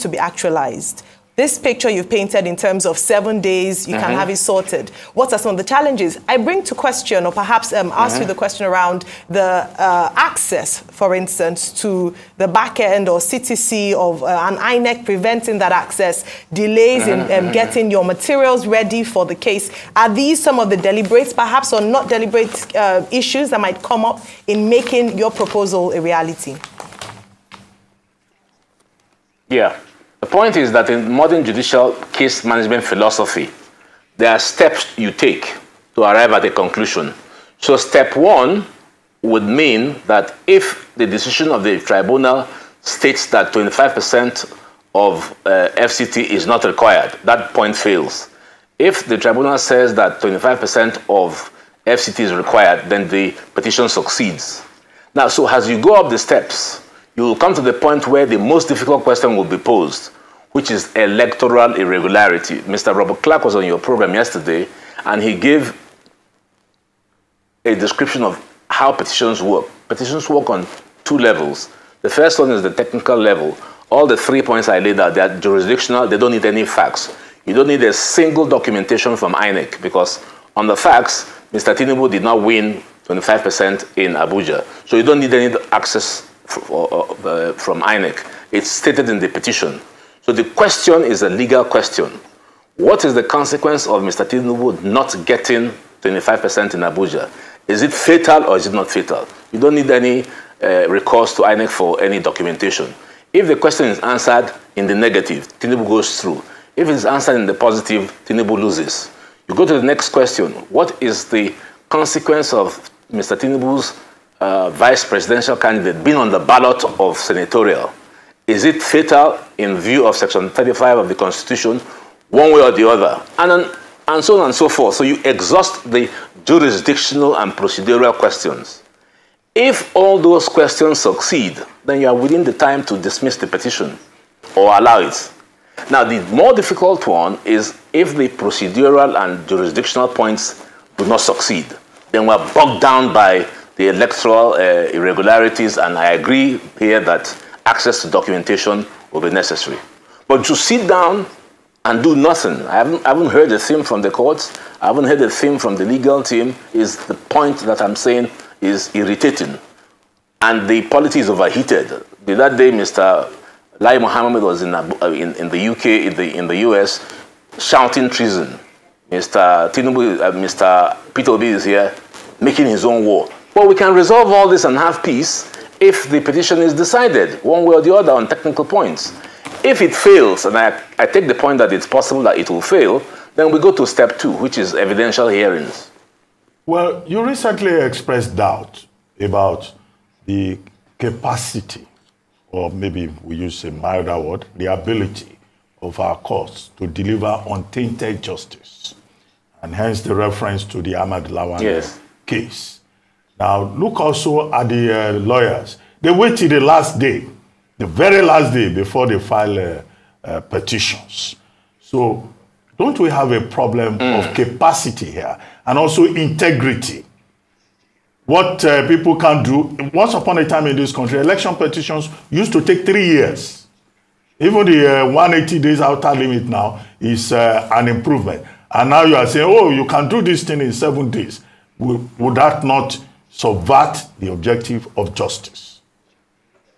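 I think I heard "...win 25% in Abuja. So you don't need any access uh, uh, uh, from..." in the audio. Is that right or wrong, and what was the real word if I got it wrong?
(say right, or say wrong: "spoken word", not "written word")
right.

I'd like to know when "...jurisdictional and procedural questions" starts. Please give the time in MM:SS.
02:06.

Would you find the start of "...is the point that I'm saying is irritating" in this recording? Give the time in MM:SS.
02:36.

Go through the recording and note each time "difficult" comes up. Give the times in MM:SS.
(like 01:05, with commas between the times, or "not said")
00:58, 02:16.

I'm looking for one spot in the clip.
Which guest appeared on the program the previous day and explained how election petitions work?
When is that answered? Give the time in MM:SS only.
01:02.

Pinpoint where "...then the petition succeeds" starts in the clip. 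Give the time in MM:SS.
00:52.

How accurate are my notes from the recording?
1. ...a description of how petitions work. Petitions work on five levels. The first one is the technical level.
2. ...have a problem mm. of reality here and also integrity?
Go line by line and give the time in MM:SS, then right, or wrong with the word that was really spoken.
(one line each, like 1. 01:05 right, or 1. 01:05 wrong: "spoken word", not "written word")
1. 01:07 wrong: "two", not "five"
2. 03:33 wrong: "capacity", not "reality".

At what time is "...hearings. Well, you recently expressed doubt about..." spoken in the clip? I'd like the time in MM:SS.
03:05.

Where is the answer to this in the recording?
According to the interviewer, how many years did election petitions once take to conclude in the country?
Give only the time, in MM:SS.
03:42.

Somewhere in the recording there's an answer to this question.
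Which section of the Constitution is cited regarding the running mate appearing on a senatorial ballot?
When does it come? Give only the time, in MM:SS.
02:00.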